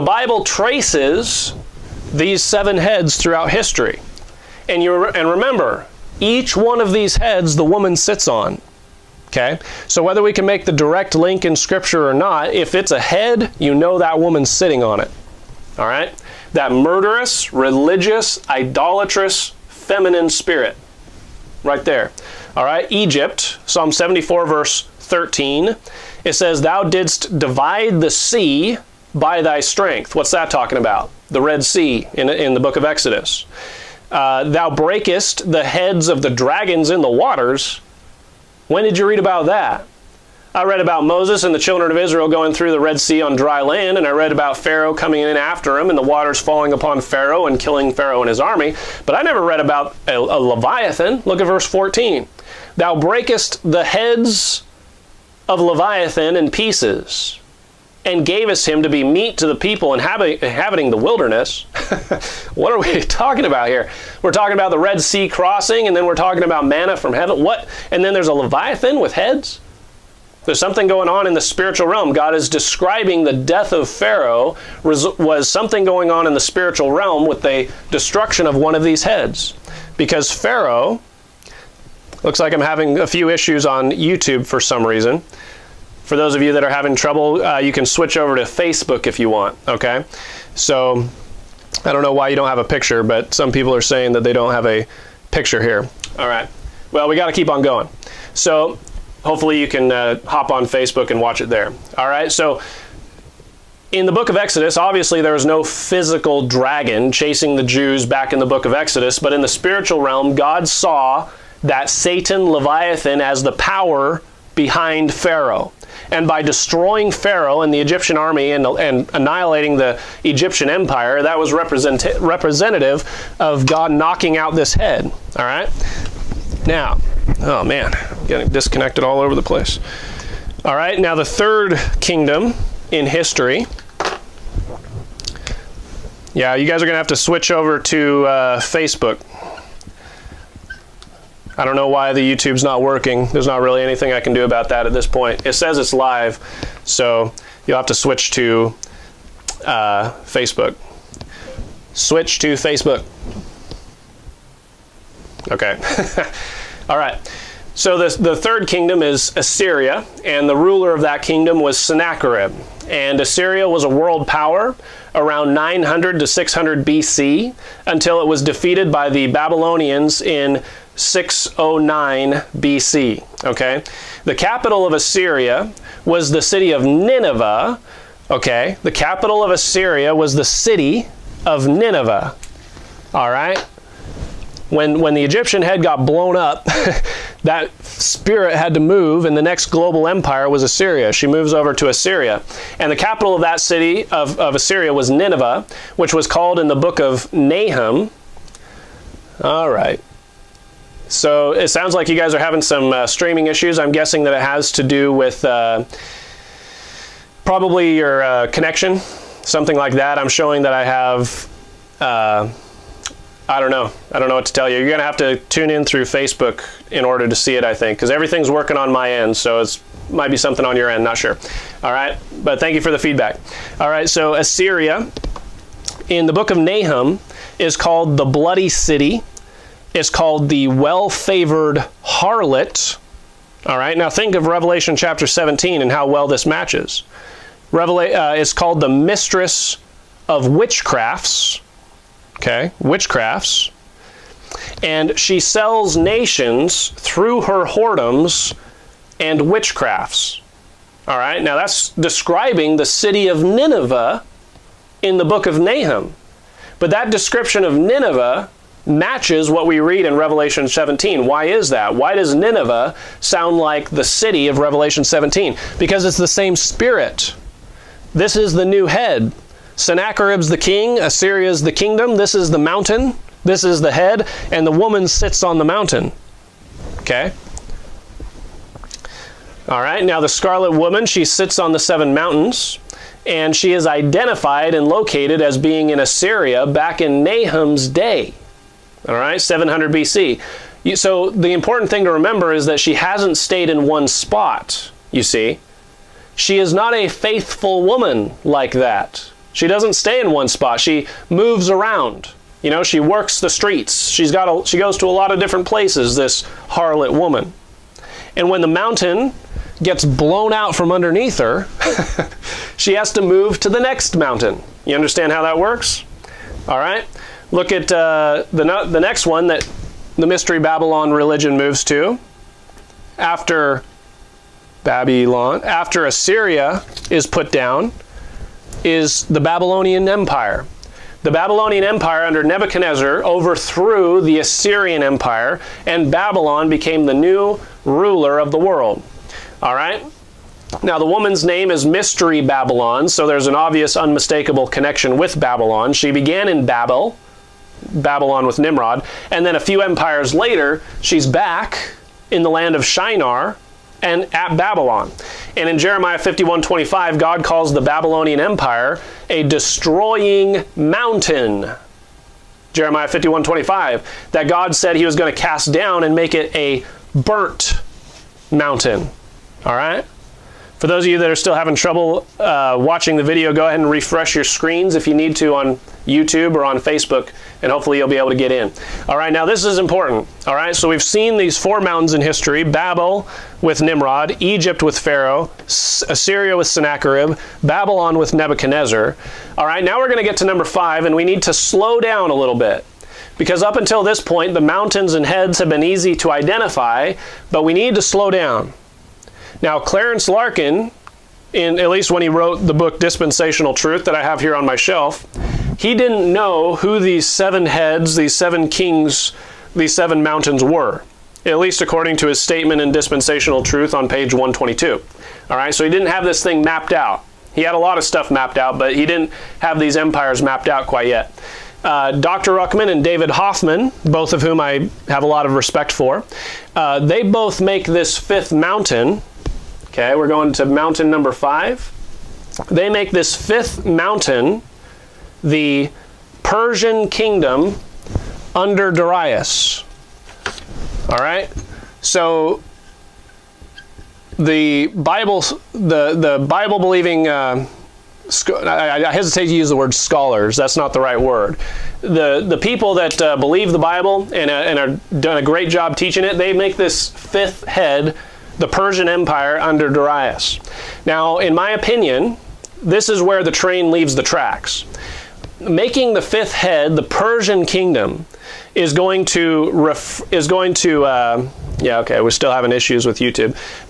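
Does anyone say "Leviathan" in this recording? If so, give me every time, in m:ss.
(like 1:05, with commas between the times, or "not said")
0:50, 0:55, 1:08, 1:52.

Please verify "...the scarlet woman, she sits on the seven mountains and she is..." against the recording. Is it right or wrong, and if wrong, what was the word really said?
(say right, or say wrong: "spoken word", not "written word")
right.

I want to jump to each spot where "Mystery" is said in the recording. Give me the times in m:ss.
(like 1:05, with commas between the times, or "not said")
5:20, 5:41.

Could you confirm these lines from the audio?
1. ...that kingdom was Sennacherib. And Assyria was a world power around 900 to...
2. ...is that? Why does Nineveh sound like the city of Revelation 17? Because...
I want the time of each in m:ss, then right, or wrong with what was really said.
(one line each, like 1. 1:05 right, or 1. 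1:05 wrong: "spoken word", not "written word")
1. 2:41 right
2. 4:21 right.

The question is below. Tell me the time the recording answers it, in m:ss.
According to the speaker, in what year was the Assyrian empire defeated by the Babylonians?
2:50.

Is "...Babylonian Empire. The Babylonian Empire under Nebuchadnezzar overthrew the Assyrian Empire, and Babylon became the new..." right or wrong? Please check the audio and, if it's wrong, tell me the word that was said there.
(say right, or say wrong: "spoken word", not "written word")
right.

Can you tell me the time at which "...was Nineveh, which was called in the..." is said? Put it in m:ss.
3:14.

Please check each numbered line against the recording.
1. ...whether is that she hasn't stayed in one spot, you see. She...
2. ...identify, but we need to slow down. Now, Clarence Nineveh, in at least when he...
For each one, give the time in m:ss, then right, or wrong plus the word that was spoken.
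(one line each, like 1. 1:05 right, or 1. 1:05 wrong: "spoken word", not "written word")
1. 4:52 wrong: "remember", not "whether"
2. 6:36 wrong: "Larkin", not "Nineveh".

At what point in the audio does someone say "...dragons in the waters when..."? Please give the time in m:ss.
0:36.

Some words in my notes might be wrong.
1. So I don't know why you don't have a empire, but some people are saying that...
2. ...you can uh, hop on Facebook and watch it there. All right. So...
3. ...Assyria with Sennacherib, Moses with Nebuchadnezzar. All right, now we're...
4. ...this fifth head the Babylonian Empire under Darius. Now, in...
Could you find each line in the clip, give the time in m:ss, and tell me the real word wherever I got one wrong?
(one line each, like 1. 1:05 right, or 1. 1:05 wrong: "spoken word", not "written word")
1. 1:30 wrong: "picture", not "empire"
2. 1:39 right
3. 6:25 wrong: "Babylon", not "Moses"
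4. 7:36 wrong: "Persian", not "Babylonian".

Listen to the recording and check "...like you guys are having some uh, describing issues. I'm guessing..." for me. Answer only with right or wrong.
wrong.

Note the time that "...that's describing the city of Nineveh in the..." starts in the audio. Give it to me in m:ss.
4:11.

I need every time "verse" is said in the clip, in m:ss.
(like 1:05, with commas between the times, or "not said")
0:24, 0:51.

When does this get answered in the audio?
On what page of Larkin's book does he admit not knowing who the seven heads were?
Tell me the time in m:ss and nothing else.
6:54.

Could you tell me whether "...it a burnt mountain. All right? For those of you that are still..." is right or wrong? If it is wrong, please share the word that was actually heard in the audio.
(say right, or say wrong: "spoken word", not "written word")
right.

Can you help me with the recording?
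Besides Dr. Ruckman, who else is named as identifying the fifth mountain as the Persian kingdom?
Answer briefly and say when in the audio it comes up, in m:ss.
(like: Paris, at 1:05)
David Hoffman, at 7:03.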